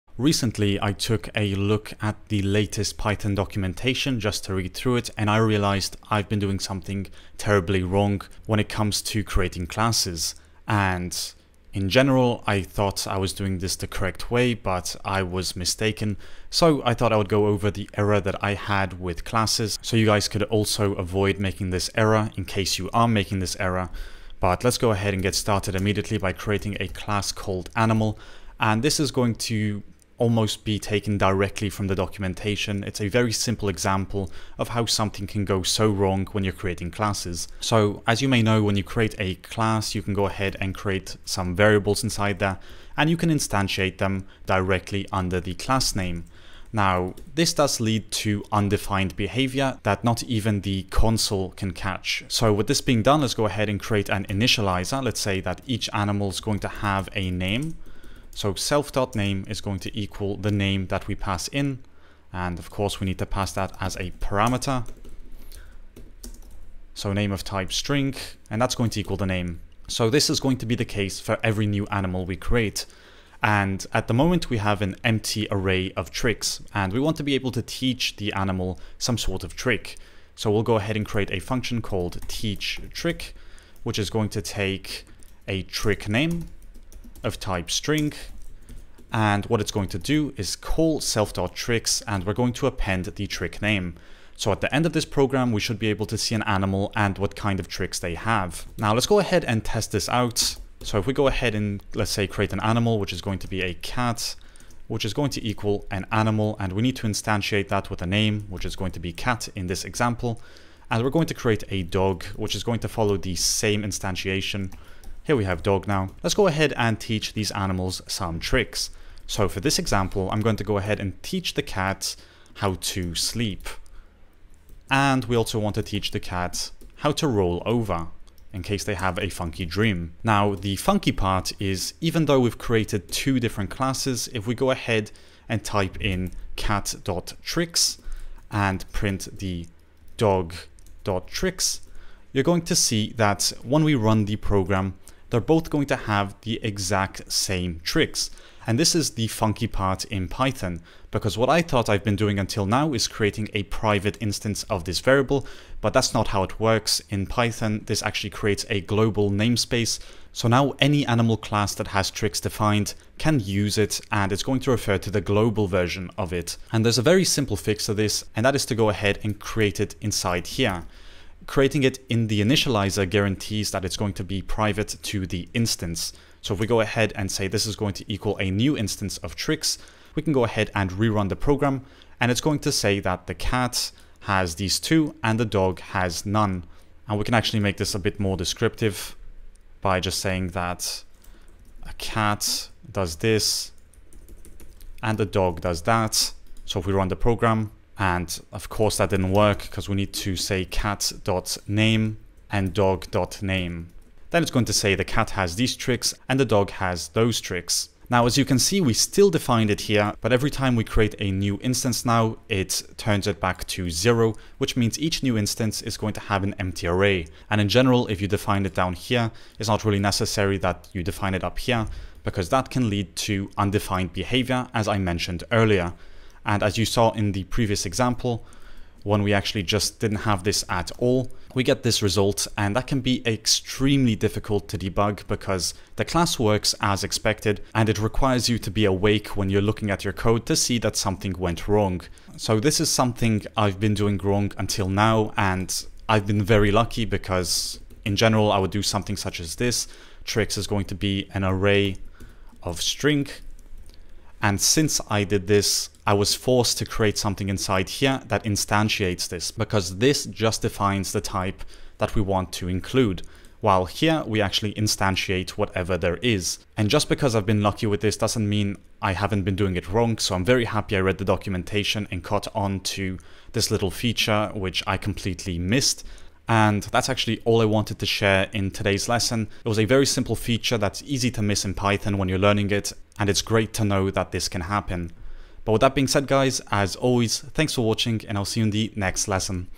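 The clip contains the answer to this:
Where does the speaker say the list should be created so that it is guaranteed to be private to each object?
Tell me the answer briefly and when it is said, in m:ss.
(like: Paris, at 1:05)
the initializer, at 2:52.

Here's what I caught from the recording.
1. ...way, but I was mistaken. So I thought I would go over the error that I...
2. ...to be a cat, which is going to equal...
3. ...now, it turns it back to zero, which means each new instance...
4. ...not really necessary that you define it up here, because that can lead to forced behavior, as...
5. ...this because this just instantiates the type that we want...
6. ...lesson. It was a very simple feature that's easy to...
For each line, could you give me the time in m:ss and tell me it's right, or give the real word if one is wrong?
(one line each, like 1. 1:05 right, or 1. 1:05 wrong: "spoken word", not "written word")
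1. 0:14 right
2. 1:43 right
3. 3:32 right
4. 3:39 wrong: "undefined", not "forced"
5. 4:19 wrong: "defines", not "instantiates"
6. 4:39 right.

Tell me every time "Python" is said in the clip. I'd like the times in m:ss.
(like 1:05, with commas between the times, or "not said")
0:02, 2:30, 2:37, 4:41.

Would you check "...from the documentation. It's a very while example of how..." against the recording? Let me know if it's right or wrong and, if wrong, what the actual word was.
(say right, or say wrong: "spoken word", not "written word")
wrong: "simple", not "while".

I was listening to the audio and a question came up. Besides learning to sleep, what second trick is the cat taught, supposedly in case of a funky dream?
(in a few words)
roll over.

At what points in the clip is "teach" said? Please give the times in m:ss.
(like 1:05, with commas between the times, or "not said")
1:17, 1:22, 1:56, 2:01, 2:05.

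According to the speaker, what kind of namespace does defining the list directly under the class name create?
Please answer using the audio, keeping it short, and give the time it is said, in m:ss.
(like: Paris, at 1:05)
global namespace, at 2:38.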